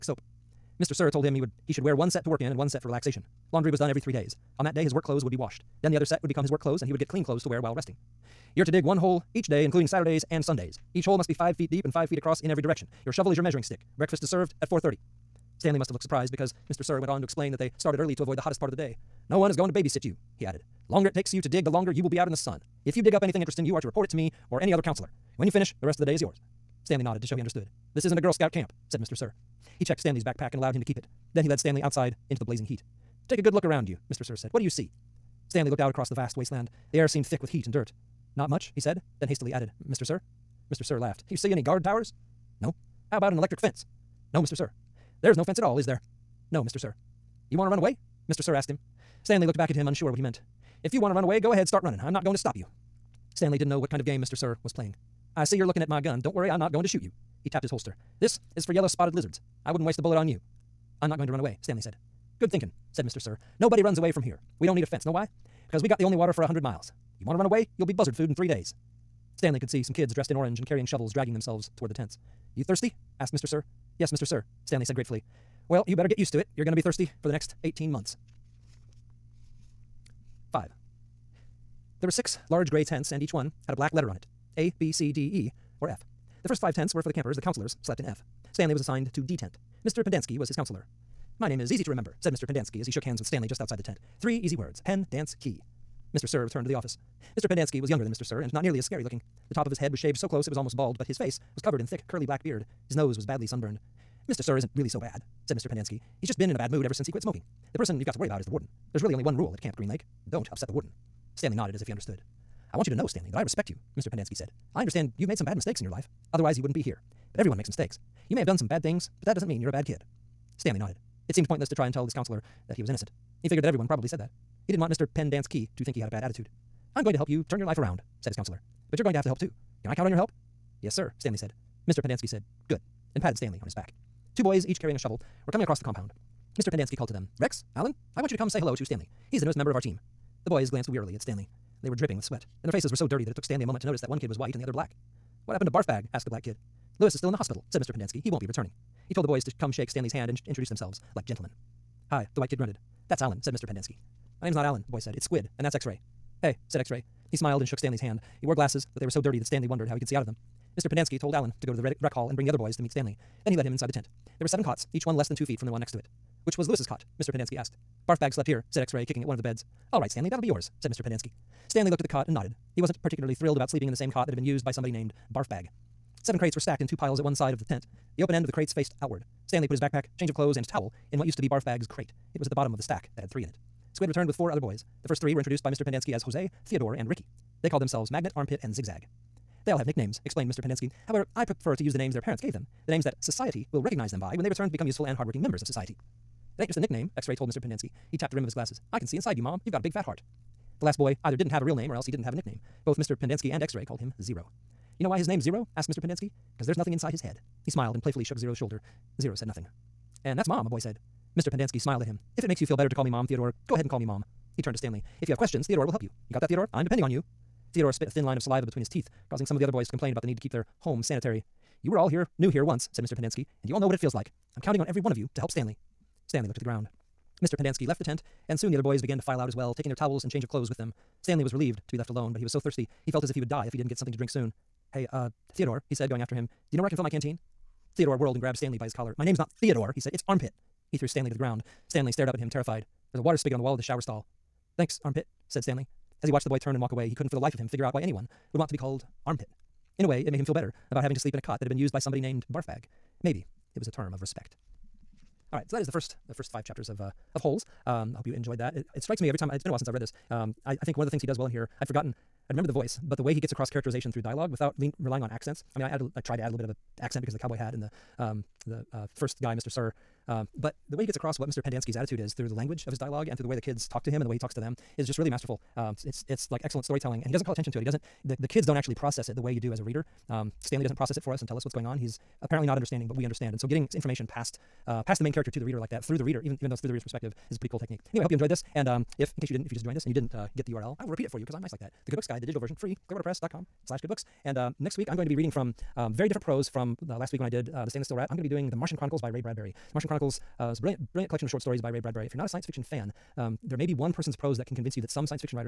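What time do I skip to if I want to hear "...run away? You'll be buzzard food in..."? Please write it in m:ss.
1:07.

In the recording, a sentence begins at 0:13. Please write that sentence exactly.
Your shovel is your measuring stick.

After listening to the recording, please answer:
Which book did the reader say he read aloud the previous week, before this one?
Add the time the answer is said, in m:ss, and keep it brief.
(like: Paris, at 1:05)
The Stainless Steel Rat, at 4:57.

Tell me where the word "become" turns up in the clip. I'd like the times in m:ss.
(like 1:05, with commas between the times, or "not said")
0:06, 3:14.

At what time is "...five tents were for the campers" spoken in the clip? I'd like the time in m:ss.
1:26.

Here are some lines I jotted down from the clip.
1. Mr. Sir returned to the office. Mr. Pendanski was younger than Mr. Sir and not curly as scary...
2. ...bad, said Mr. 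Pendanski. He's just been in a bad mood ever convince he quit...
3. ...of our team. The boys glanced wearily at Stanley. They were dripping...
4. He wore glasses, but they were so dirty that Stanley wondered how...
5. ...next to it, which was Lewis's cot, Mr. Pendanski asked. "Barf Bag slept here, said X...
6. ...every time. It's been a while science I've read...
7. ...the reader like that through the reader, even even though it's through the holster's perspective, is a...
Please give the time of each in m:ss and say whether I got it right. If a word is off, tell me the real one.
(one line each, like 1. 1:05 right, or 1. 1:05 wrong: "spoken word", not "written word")
1. 1:36 wrong: "nearly", not "curly"
2. 1:44 wrong: "since", not "convince"
3. 2:19 right
4. 2:38 right
5. 2:45 right
6. 4:19 wrong: "since", not "science"
7. 4:45 wrong: "reader", not "holster".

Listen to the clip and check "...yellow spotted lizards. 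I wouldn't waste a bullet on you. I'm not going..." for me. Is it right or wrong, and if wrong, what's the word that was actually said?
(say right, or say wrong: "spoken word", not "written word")
right.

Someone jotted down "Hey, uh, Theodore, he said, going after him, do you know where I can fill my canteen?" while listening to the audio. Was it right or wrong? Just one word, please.
right.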